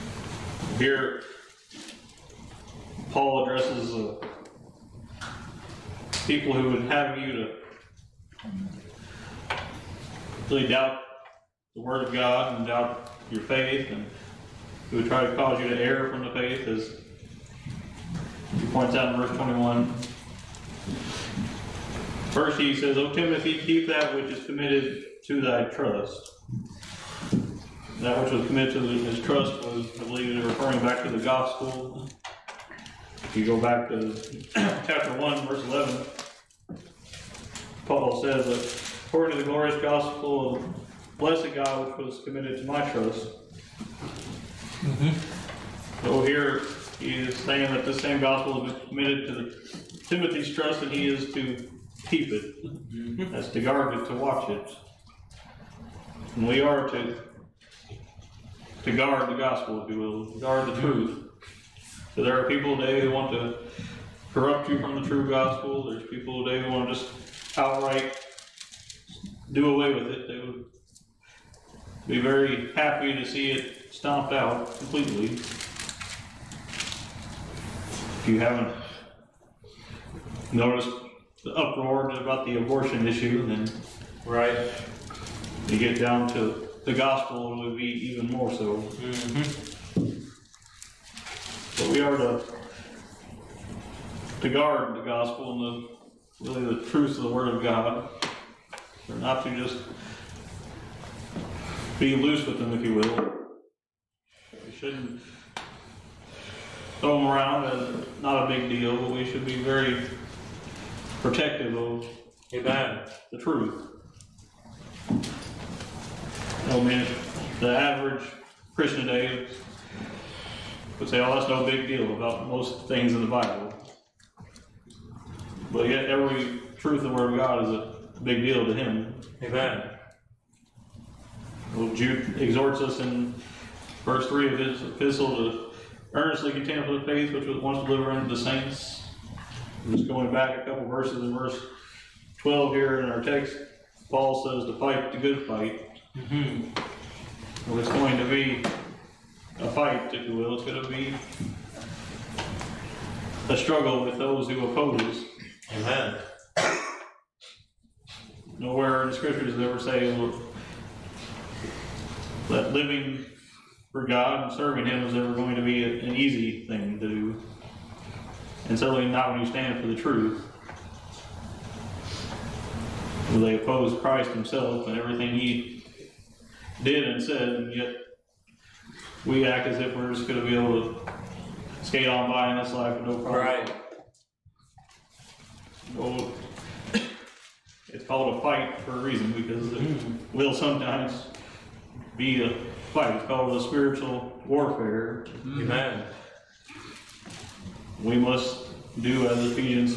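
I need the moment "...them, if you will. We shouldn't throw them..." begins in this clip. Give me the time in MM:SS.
01:42.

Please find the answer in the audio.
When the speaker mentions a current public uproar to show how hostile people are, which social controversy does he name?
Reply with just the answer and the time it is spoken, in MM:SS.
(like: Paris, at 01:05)
Abortion, at 01:22.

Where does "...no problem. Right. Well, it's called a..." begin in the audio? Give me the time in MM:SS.
03:03.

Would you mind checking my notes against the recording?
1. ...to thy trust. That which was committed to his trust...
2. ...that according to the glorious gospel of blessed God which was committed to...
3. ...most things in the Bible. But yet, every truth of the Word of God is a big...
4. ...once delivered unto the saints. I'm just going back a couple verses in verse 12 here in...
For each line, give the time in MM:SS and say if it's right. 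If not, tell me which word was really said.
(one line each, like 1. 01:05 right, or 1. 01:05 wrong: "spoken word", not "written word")
1. 00:25 right
2. 00:38 right
3. 02:02 right
4. 02:17 right.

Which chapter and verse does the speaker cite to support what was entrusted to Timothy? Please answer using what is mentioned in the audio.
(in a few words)
Chapter 1, verse 11.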